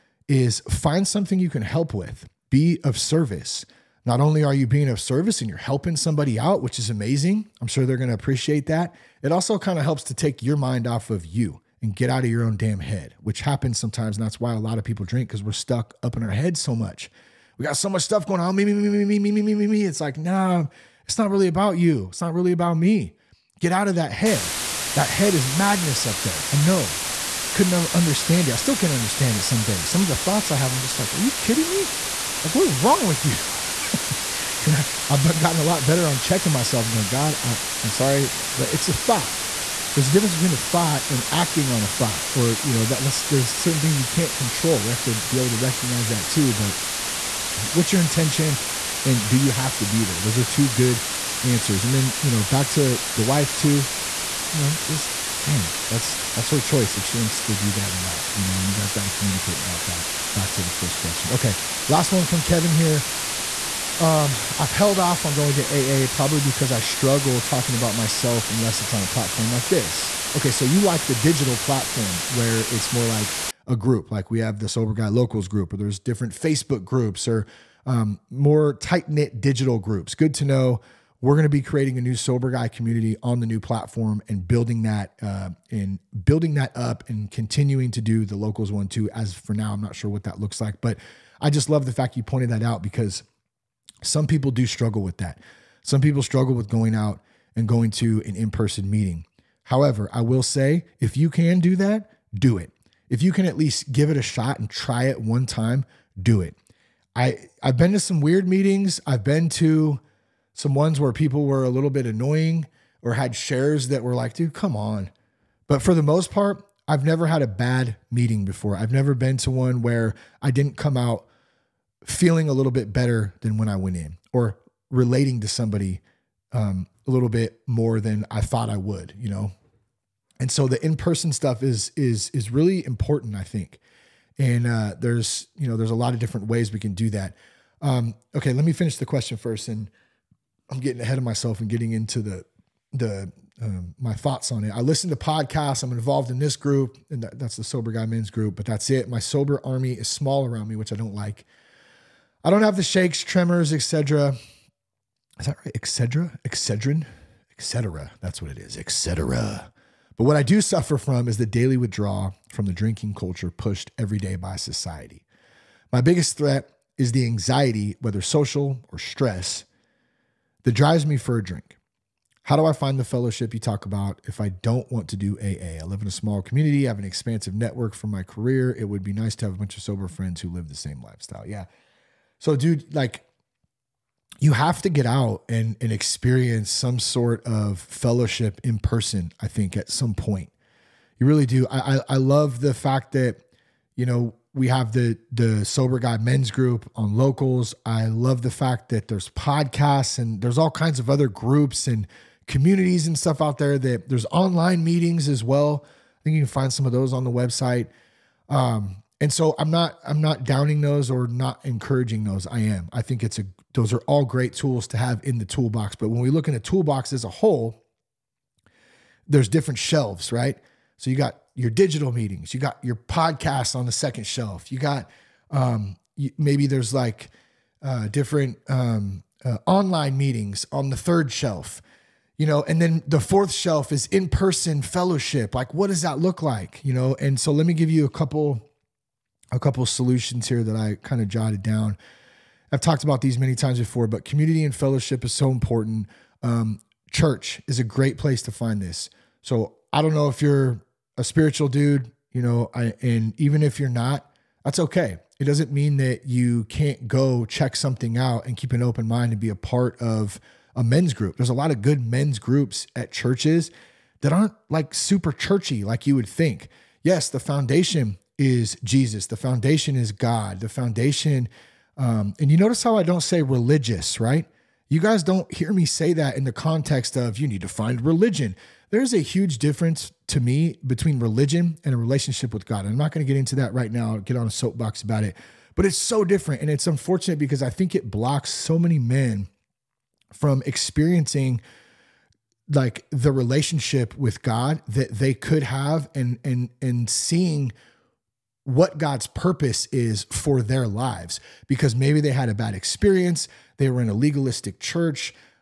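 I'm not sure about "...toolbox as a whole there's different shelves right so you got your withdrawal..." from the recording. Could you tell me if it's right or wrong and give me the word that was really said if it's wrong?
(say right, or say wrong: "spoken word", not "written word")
wrong: "digital", not "withdrawal".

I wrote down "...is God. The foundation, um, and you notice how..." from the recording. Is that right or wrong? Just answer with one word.
right.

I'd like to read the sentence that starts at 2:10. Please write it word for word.
And so the in-person stuff is, is, is really important, I think.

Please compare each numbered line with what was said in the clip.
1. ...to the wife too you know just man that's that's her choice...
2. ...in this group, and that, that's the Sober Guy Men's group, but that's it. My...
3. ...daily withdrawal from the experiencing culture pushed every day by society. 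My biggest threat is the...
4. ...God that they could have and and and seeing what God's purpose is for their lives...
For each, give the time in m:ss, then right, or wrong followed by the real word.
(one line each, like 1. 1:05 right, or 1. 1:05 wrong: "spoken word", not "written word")
1. 0:52 right
2. 2:26 right
3. 2:41 wrong: "drinking", not "experiencing"
4. 4:54 right.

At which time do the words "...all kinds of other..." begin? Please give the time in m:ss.
3:20.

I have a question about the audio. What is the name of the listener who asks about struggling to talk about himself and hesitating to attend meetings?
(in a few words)
Kevin.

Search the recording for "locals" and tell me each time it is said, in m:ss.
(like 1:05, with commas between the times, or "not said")
1:15, 1:28, 3:17.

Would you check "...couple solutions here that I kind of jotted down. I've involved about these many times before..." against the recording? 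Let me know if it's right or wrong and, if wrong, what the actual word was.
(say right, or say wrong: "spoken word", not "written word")
wrong: "talked", not "involved".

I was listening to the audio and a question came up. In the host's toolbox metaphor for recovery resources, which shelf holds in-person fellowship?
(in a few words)
fourth shelf.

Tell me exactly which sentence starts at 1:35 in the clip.
Some people struggle with going out and going to an in person meeting.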